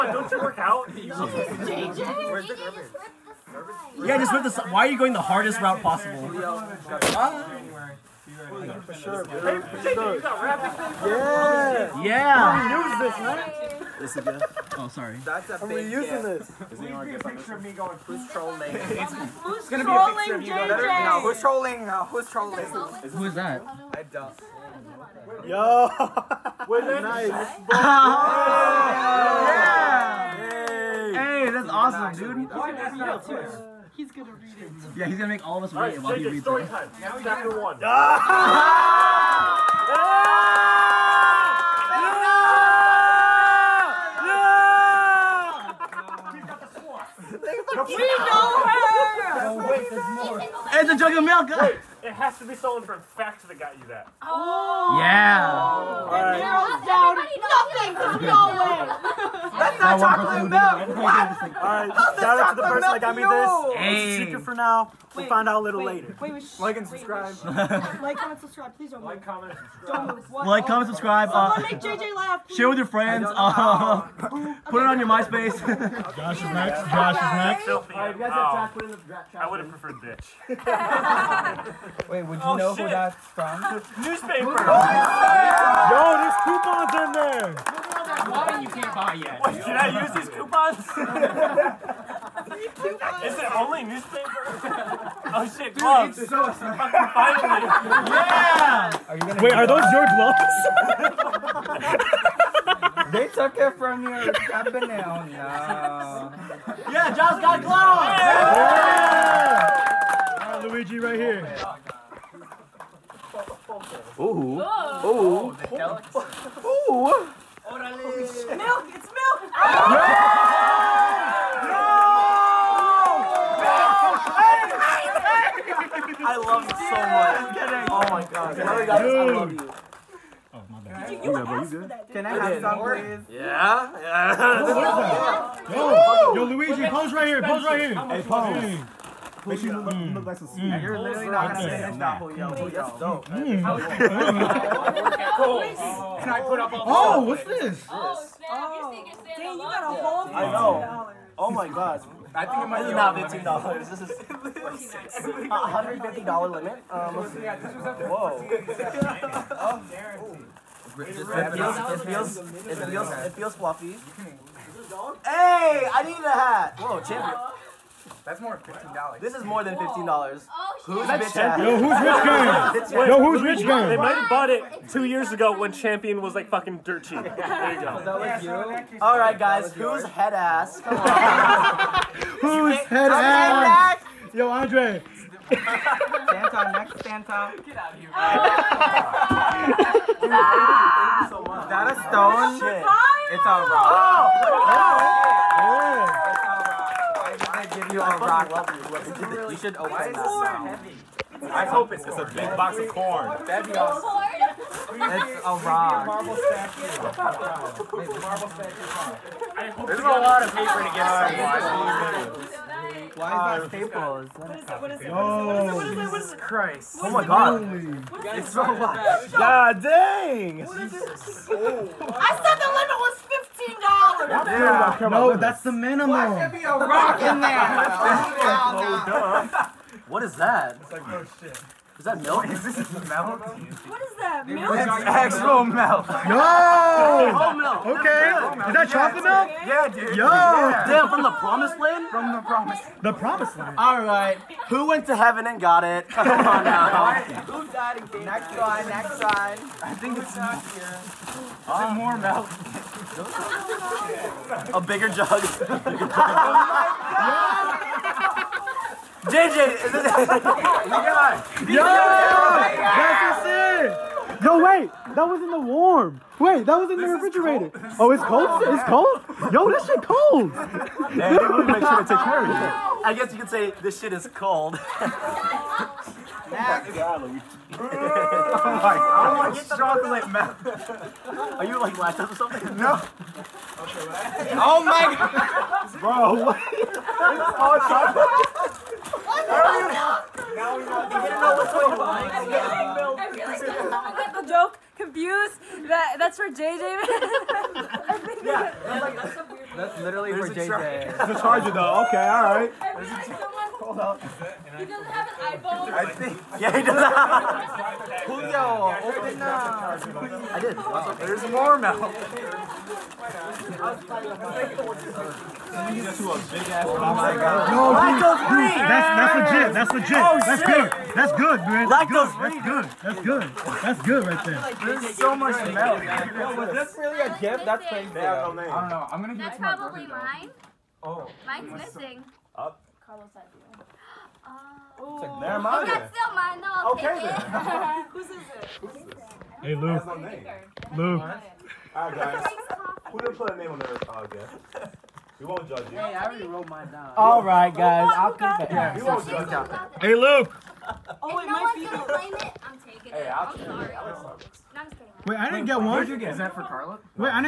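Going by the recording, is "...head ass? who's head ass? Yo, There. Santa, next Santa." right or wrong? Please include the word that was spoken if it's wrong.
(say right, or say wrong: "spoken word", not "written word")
wrong: "Andre", not "There".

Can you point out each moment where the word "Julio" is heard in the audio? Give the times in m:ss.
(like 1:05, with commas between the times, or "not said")
5:08.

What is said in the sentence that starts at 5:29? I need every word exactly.
I'm gonna give it to my That's probably mine.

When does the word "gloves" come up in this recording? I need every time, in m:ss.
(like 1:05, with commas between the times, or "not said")
1:35, 1:40, 1:47.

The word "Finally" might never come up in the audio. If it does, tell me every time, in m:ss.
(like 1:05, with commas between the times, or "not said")
1:36.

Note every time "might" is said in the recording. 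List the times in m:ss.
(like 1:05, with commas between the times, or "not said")
2:32, 2:53, 5:51.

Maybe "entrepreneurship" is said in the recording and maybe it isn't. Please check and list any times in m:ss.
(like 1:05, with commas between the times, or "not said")
not said.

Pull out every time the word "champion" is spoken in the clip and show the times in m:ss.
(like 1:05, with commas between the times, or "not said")
2:47, 2:55.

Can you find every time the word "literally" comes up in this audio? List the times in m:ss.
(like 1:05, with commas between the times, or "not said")
2:20, 5:00.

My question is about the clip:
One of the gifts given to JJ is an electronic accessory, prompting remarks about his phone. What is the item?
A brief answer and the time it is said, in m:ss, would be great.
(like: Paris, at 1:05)
A charger, at 5:01.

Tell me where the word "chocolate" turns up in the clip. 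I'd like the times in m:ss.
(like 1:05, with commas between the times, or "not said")
1:00, 3:58, 4:39, 4:47.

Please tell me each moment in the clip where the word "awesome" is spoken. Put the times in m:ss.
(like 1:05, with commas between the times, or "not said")
0:31, 3:23.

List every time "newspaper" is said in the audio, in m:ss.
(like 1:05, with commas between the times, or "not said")
1:24, 1:33.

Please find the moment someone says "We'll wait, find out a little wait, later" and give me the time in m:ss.
1:05.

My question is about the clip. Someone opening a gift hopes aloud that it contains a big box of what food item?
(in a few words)
Corn.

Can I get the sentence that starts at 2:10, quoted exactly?
Oh, You, you, you, asked for that, Can I have some, please?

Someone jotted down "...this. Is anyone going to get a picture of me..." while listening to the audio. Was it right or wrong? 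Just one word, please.
right.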